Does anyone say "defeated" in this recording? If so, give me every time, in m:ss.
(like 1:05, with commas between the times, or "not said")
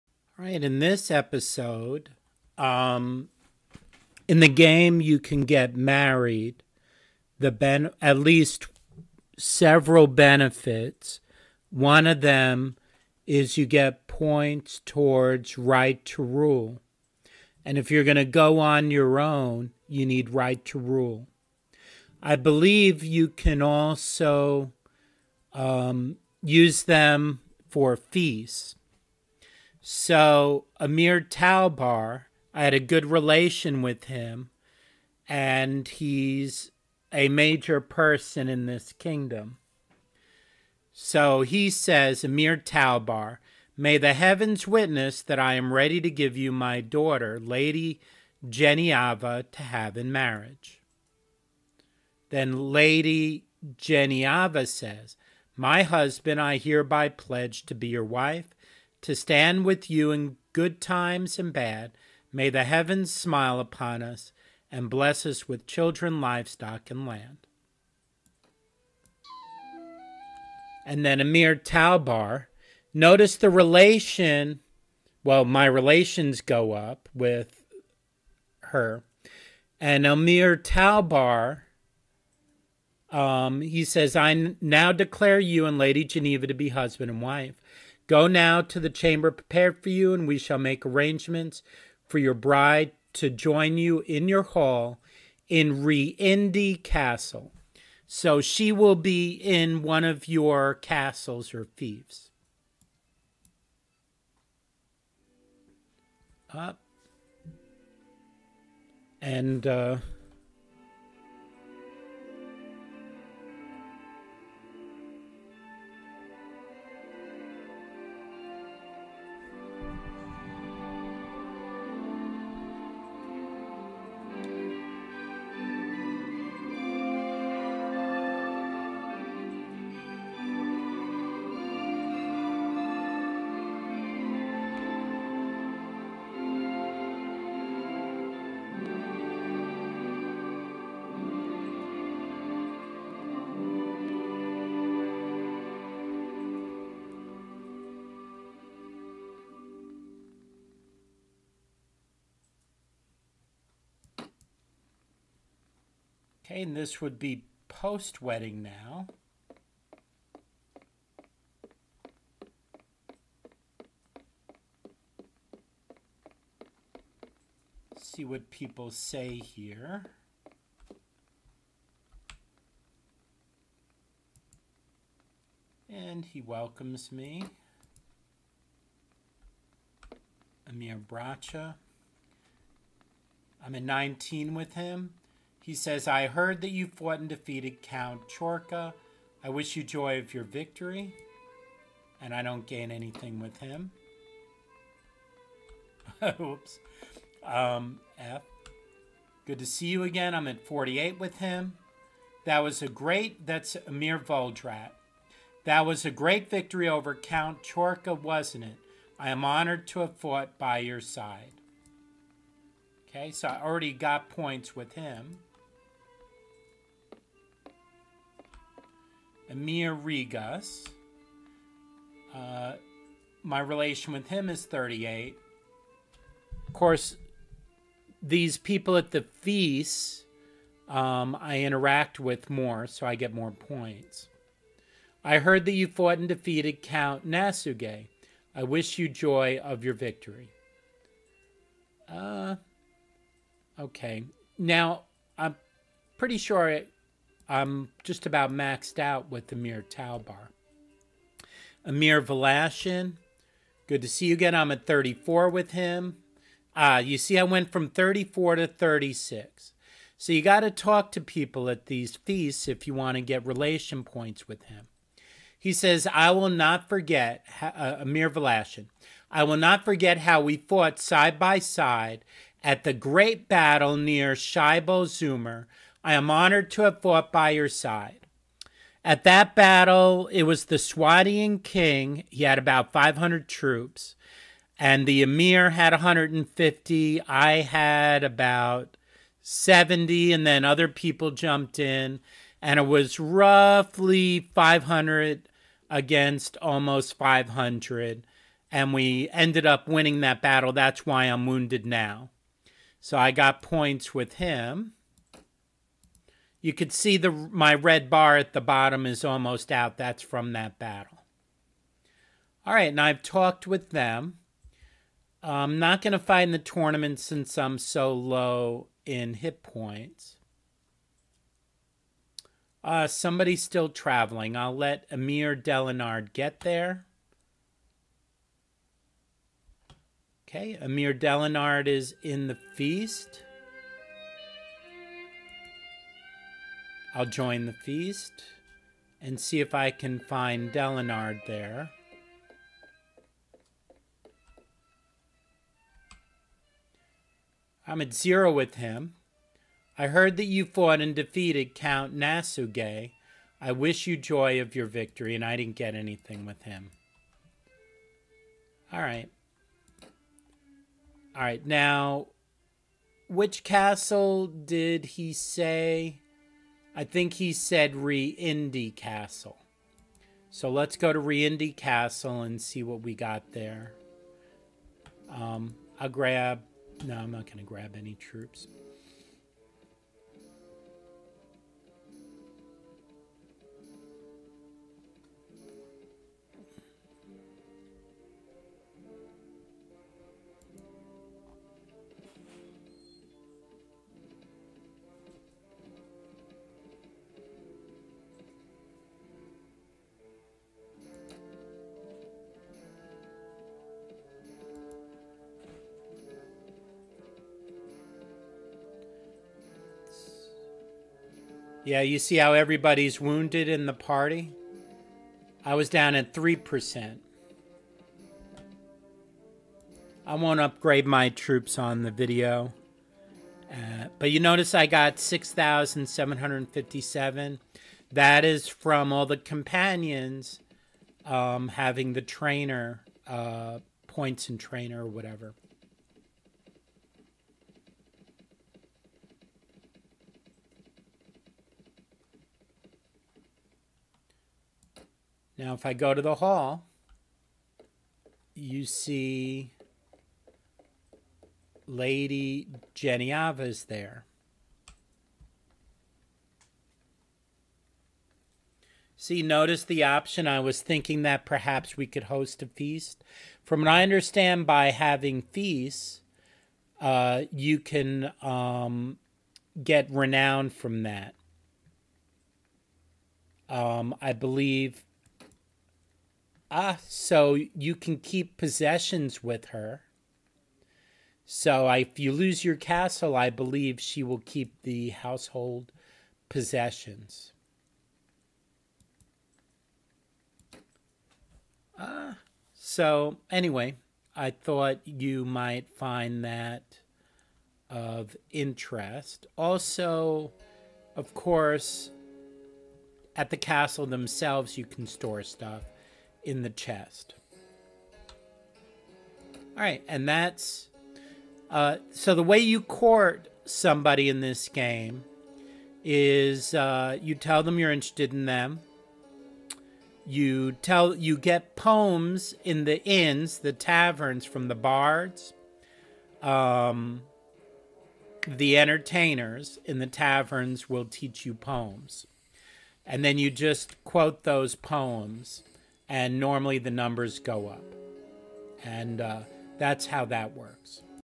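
3:07, 3:56, 5:51.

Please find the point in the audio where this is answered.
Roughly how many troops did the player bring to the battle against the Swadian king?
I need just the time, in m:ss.
4:49.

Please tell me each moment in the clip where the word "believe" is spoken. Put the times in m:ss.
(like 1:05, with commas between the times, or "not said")
0:22, 7:54, 8:03.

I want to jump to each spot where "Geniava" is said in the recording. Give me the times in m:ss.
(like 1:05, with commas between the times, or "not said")
0:48, 0:53.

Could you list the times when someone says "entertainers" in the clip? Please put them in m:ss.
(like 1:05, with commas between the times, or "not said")
8:48.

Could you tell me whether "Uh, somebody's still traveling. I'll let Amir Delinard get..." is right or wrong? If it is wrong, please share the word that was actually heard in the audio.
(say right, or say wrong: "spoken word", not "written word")
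right.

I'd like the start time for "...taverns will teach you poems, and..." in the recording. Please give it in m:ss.
8:50.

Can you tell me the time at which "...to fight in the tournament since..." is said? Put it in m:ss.
5:16.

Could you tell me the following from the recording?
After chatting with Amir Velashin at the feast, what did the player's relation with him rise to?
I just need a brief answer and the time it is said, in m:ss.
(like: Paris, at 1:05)
36, at 4:18.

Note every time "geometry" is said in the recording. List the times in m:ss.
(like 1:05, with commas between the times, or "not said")
not said.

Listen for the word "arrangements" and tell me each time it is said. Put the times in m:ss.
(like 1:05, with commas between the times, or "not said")
1:30.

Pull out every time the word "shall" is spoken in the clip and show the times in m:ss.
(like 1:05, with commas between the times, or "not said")
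1:30.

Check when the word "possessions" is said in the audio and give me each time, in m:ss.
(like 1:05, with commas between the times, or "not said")
7:58, 8:06.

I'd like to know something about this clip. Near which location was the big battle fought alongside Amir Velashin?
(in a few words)
Shibal Zumr.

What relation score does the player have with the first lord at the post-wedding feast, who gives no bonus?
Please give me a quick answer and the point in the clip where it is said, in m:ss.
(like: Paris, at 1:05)
19, at 3:03.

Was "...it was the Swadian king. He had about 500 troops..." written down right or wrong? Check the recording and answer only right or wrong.
right.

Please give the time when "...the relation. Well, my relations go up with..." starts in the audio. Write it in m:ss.
1:13.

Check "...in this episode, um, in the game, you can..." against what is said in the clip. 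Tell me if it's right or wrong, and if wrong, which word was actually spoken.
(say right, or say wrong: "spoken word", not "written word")
right.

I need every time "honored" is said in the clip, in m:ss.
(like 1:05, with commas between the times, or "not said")
3:29, 4:36.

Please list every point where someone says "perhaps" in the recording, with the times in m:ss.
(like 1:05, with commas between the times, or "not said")
7:41.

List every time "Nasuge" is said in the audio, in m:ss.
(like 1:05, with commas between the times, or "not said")
3:57, 5:52.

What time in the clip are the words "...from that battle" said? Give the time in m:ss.
5:10.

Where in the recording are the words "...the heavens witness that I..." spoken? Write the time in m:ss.
0:43.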